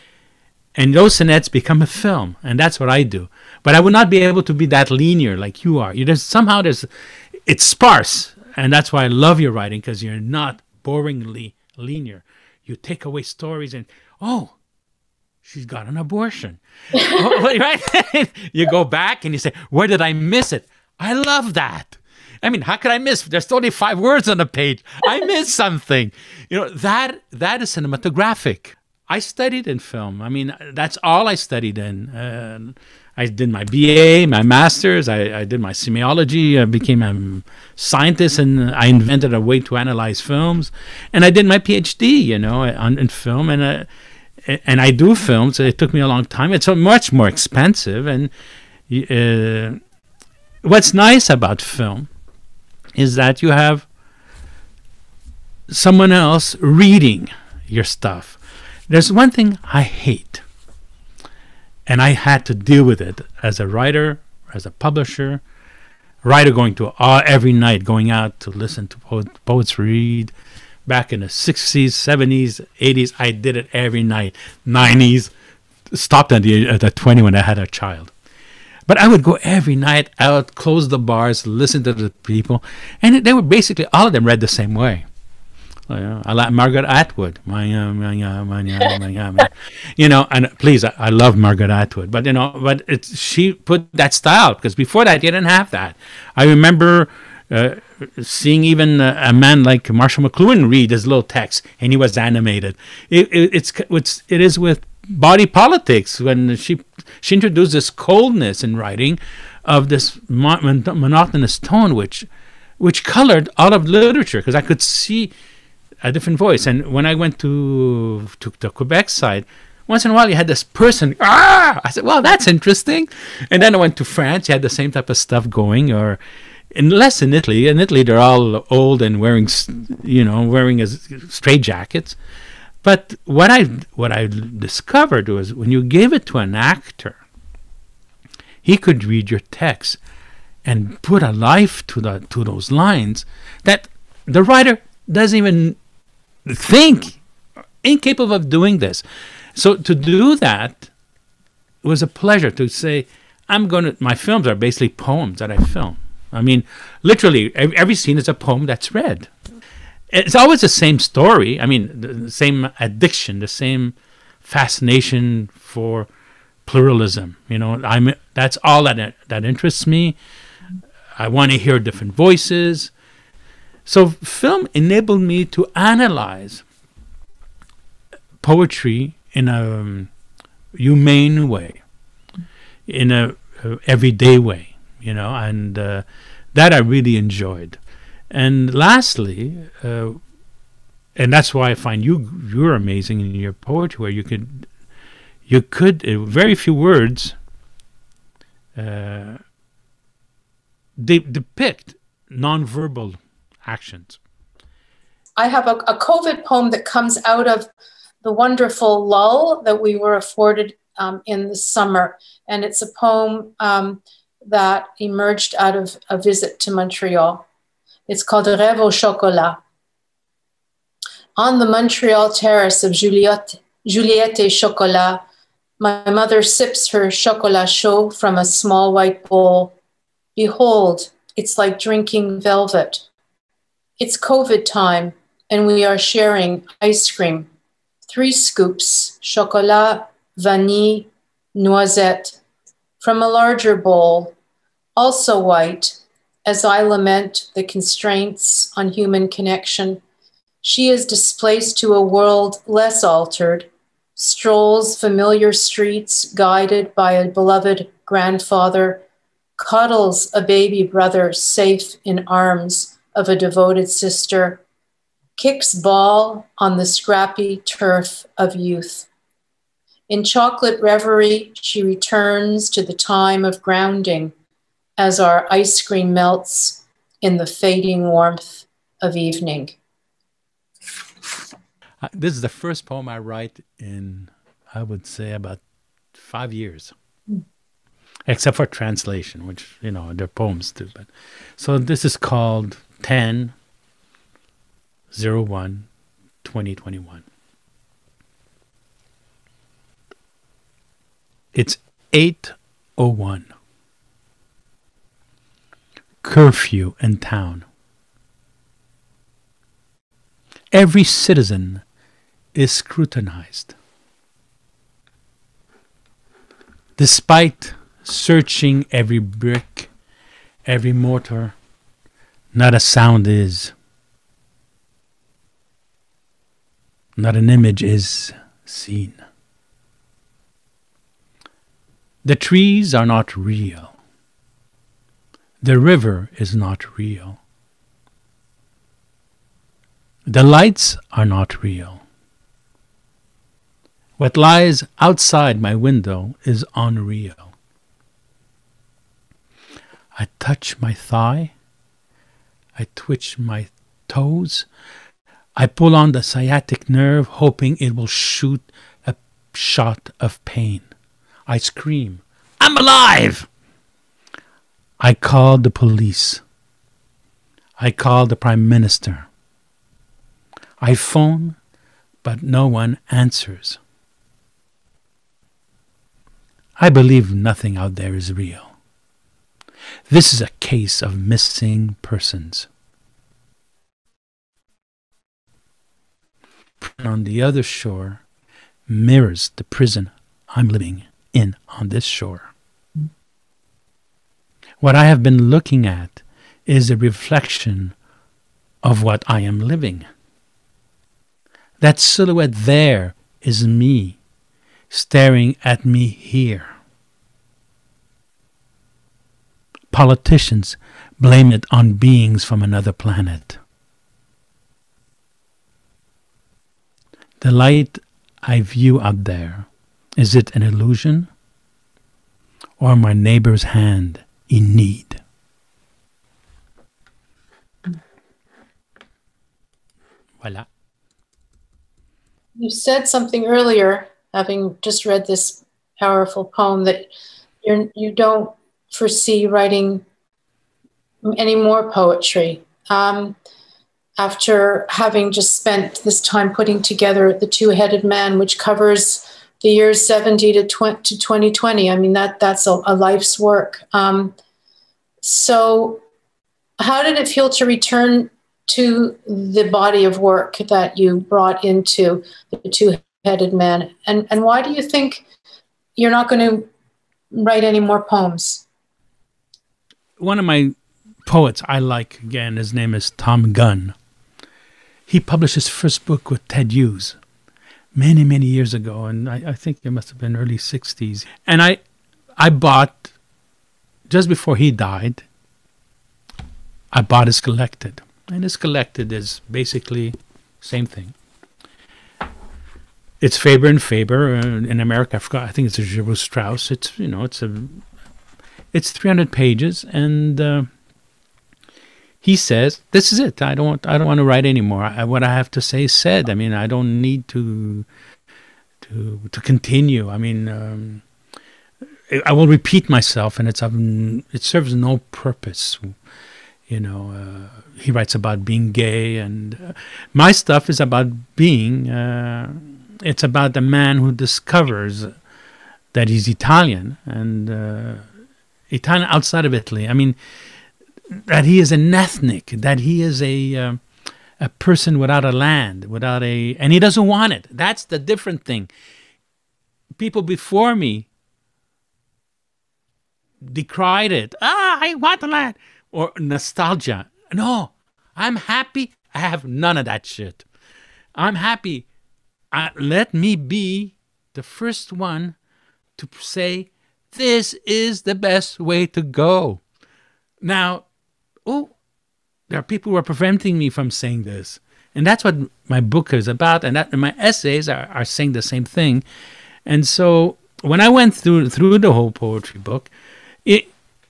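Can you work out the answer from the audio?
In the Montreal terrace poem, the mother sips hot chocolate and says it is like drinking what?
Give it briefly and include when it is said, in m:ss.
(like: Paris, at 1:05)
Velvet, at 3:52.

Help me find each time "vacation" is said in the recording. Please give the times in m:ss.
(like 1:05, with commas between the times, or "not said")
not said.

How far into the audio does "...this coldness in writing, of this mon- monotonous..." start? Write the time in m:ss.
1:47.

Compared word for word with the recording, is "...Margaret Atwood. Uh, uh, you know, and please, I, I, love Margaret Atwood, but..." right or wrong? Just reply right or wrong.
right.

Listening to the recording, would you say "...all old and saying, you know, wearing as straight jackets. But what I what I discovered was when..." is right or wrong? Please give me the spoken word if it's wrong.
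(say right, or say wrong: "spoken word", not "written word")
wrong: "wearing", not "saying".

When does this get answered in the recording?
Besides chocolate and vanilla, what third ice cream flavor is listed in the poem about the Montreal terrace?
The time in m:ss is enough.
4:01.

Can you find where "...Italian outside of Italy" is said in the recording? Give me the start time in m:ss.
8:48.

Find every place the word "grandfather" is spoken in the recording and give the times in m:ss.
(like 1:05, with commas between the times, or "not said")
4:18.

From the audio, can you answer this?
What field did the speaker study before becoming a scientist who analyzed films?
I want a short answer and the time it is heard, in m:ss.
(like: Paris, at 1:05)
Semiology, at 0:35.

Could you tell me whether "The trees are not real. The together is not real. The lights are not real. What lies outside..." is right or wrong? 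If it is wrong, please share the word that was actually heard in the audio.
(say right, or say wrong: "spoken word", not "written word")
wrong: "river", not "together".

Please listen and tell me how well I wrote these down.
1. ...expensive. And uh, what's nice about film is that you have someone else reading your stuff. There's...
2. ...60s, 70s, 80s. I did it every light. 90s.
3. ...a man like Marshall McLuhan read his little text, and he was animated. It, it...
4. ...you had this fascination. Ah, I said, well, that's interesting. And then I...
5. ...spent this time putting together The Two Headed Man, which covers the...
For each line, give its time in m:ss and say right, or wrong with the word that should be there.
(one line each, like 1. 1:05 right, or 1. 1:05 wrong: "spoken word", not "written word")
1. 0:47 right
2. 1:11 wrong: "night", not "light"
3. 1:39 right
4. 2:00 wrong: "person", not "fascination"
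5. 7:25 right.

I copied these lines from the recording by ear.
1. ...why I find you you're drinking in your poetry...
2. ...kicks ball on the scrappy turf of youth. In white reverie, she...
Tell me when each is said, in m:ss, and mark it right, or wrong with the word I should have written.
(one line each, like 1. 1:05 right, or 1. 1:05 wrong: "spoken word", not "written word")
1. 3:11 wrong: "amazing", not "drinking"
2. 4:25 wrong: "chocolate", not "white".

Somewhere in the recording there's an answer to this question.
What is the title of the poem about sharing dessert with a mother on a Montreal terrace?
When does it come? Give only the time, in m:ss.
3:38.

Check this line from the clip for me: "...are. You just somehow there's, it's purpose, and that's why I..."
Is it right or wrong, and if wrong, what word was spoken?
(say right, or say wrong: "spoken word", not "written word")
wrong: "sparse", not "purpose".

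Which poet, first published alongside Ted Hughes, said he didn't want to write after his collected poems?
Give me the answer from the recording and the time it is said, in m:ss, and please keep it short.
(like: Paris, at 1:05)
Tom Gunn, at 7:53.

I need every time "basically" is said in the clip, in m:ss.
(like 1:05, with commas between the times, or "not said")
1:23, 2:34, 8:09.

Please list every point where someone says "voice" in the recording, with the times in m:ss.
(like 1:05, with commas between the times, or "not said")
1:56, 2:52.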